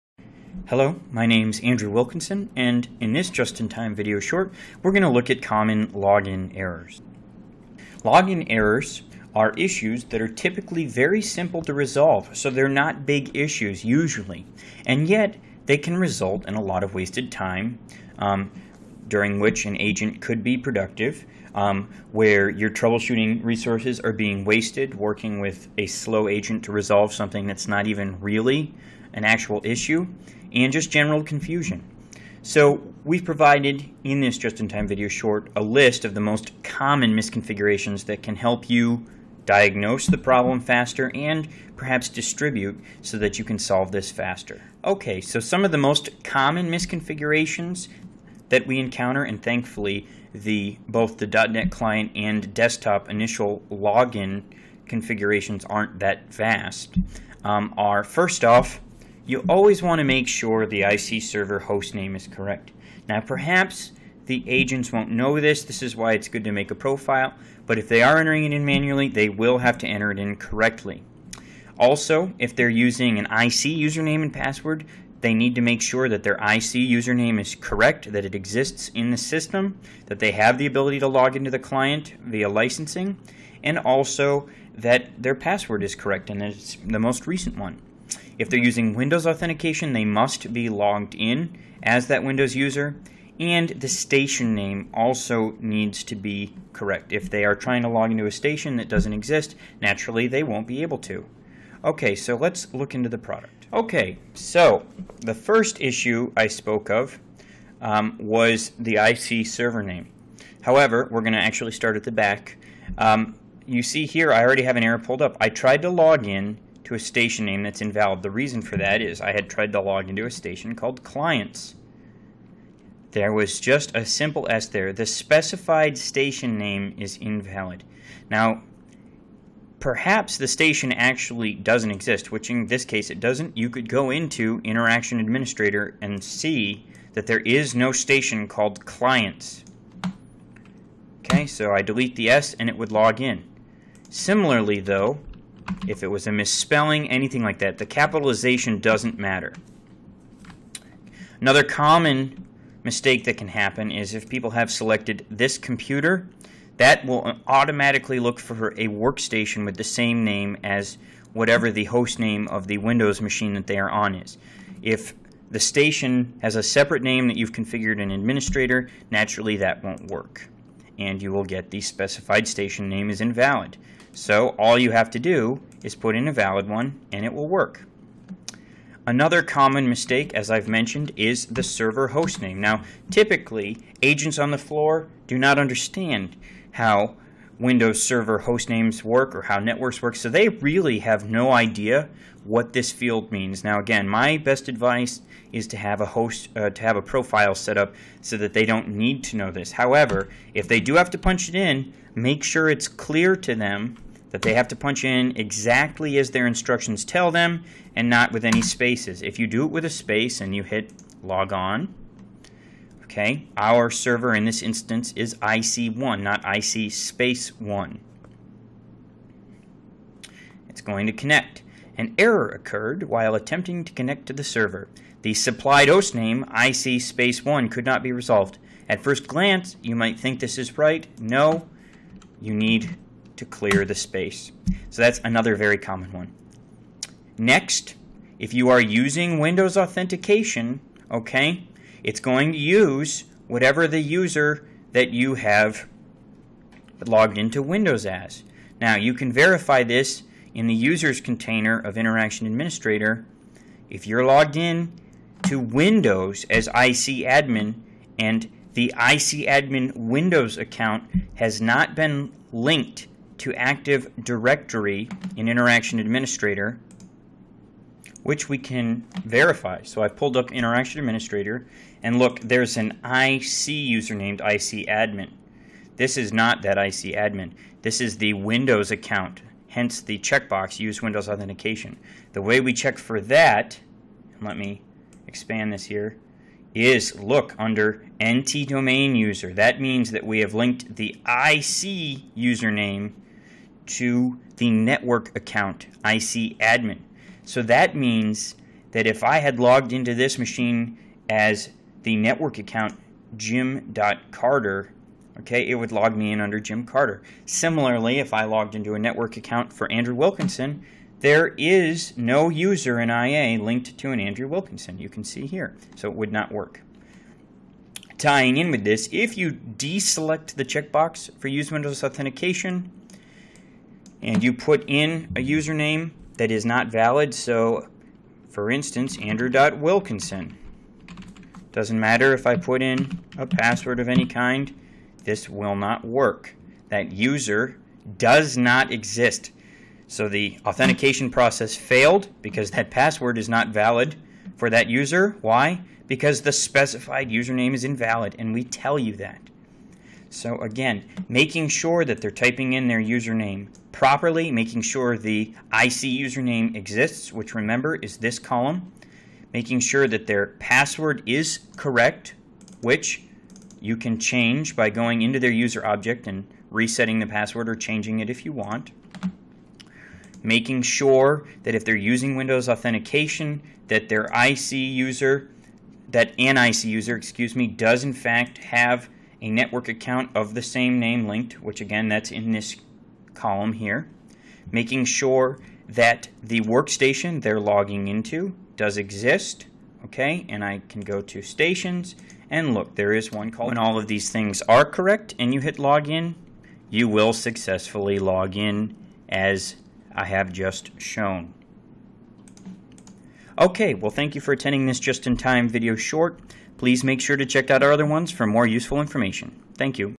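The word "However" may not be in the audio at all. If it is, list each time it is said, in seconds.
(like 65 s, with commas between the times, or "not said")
110 s, 199 s.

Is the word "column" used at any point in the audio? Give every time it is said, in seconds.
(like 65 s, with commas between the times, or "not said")
358 s, 383 s.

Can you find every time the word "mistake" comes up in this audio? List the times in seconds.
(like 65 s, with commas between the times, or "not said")
152 s, 179 s.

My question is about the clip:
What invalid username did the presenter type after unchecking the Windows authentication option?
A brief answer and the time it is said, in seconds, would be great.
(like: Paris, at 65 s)
Andrew.Wilkinson, at 329 s.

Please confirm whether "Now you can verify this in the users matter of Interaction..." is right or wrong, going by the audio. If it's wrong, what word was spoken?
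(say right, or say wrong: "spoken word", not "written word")
wrong: "container", not "matter".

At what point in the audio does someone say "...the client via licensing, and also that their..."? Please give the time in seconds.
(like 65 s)
81 s.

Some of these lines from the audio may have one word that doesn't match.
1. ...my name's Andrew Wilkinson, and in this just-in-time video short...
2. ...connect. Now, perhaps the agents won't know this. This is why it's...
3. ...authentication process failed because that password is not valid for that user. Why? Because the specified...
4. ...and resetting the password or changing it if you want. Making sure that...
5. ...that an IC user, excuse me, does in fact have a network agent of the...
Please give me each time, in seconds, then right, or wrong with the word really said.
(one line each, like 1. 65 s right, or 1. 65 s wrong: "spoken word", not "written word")
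1. 1 s right
2. 62 s wrong: "correct", not "connect"
3. 340 s right
4. 366 s right
5. 376 s wrong: "account", not "agent".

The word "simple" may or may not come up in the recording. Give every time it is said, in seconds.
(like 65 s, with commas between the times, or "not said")
11 s, 124 s.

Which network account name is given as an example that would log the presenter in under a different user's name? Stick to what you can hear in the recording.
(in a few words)
jim.carter.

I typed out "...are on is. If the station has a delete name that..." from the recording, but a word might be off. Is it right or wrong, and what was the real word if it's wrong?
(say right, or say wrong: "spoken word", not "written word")
wrong: "separate", not "delete".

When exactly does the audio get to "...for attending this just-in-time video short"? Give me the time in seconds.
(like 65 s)
404 s.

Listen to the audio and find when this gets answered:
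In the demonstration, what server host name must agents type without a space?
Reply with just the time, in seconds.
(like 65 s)
215 s.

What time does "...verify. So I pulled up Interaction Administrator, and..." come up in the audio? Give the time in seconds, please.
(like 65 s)
269 s.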